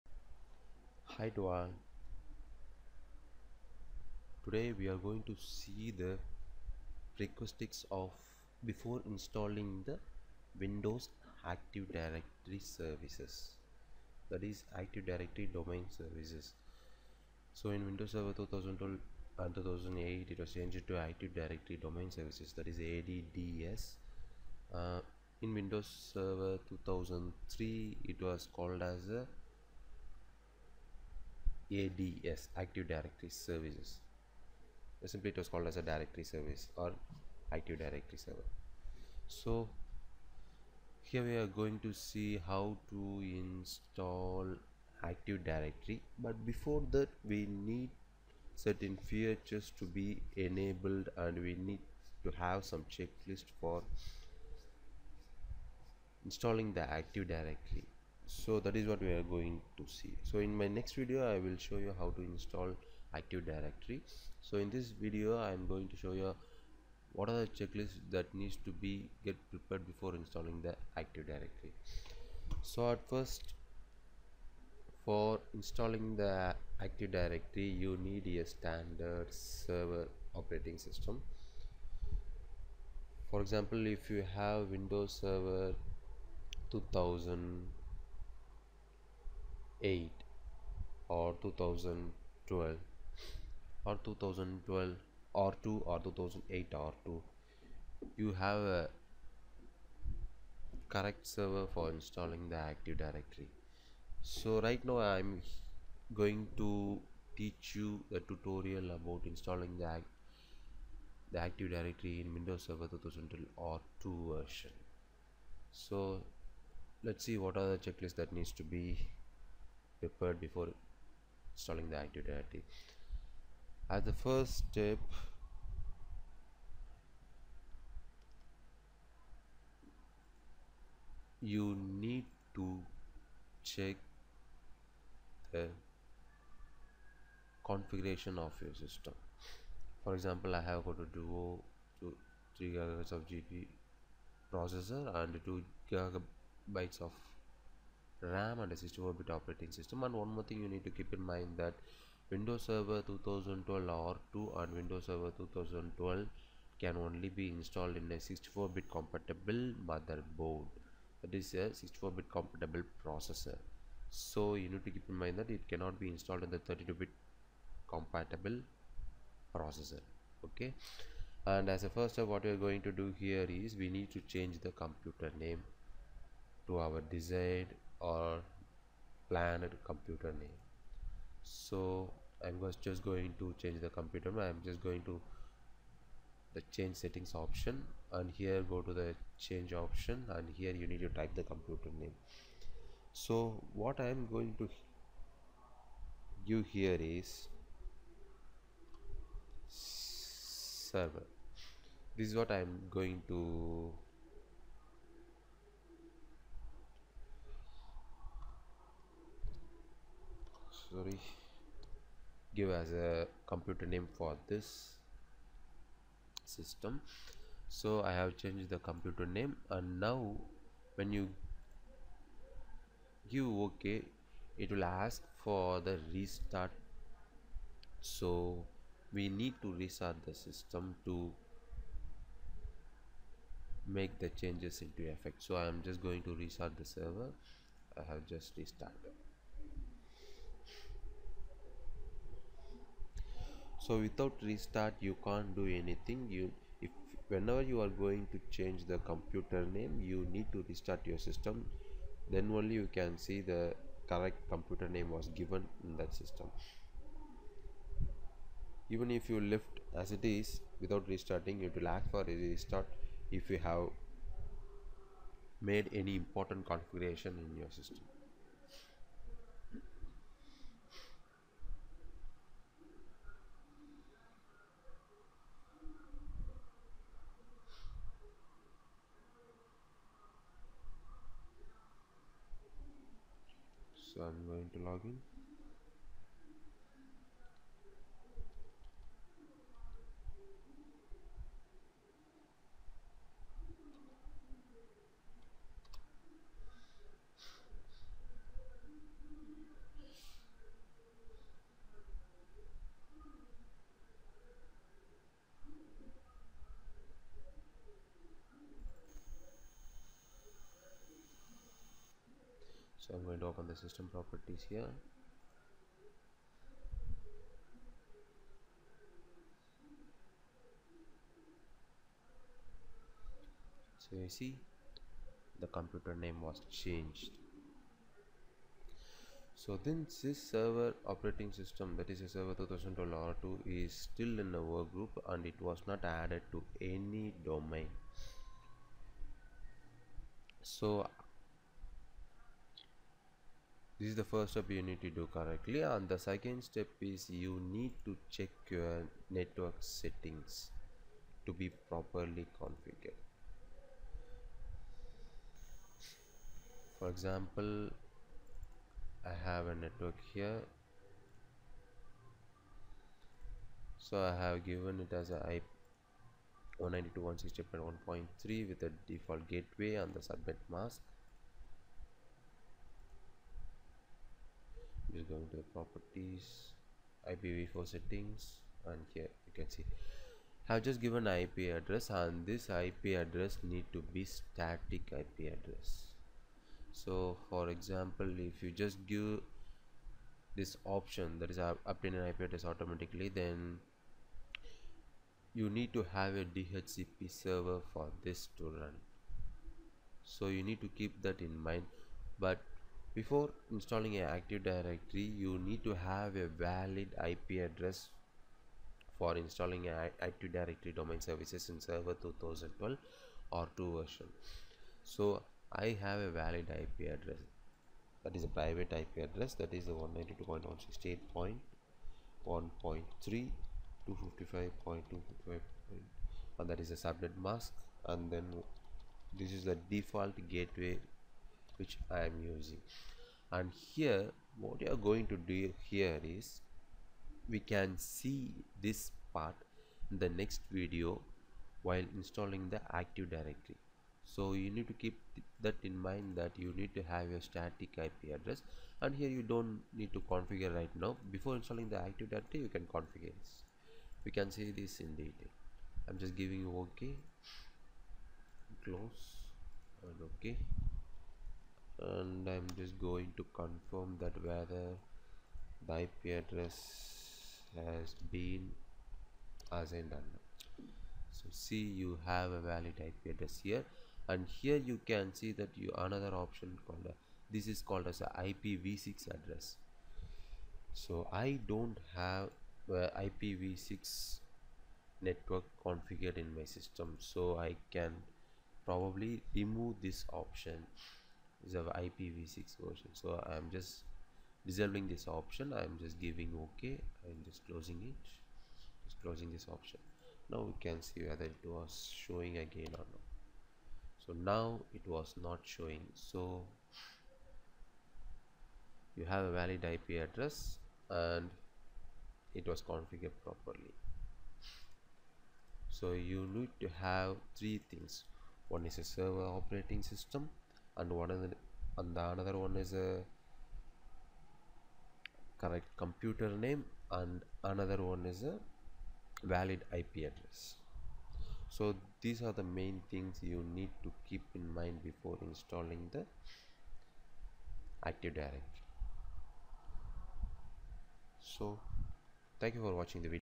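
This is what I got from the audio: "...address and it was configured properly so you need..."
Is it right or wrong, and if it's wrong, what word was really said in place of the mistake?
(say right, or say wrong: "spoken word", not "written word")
right.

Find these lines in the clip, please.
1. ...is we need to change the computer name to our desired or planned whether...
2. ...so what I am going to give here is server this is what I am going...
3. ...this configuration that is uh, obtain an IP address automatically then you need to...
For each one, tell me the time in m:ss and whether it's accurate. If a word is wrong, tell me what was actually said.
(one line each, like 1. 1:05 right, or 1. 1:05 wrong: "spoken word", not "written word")
1. 2:53 wrong: "computer", not "whether"
2. 3:13 right
3. 6:30 wrong: "option", not "configuration".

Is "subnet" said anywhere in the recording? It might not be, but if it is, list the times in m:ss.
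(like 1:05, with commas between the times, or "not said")
6:10, 7:06.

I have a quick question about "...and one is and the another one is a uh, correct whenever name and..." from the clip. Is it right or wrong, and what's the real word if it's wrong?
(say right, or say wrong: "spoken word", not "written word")
wrong: "computer", not "whenever".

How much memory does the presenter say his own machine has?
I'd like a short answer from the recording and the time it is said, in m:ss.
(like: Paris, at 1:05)
2 GB, at 2:25.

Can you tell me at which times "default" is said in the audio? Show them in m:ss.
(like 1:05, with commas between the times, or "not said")
6:09, 7:09.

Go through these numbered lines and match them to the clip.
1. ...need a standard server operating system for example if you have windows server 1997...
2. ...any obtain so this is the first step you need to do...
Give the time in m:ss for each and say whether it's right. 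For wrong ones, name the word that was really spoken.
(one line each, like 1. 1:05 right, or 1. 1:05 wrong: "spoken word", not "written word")
1. 1:18 wrong: "2000", not "1997"
2. 5:36 wrong: "domain", not "obtain".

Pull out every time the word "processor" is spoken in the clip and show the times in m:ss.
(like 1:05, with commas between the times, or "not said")
2:24, 2:43, 2:49.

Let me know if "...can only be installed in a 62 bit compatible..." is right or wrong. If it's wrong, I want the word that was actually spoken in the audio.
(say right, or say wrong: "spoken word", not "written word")
wrong: "64", not "62".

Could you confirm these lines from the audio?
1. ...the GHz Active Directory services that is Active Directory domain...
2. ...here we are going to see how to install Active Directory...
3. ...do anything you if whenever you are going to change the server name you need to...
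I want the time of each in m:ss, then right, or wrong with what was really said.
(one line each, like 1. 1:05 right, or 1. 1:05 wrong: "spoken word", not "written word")
1. 0:09 wrong: "Windows", not "GHz"
2. 0:41 right
3. 4:05 wrong: "computer", not "server".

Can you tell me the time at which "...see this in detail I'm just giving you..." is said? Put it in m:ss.
7:34.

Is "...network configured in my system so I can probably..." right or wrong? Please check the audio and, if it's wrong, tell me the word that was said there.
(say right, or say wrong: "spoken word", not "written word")
right.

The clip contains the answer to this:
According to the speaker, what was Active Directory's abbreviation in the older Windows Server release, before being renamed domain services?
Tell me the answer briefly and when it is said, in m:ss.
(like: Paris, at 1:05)
ADS, at 0:31.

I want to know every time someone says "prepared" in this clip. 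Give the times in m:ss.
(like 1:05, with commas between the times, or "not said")
1:09, 2:00.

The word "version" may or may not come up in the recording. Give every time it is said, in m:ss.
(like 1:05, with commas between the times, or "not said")
1:54, 6:54, 8:12.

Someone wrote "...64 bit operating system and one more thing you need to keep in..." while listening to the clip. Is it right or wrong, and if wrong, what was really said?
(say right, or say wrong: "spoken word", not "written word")
right.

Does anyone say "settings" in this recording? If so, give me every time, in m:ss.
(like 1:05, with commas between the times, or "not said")
3:06, 5:49, 6:17.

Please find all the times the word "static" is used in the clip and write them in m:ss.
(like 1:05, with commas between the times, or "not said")
6:24, 7:27.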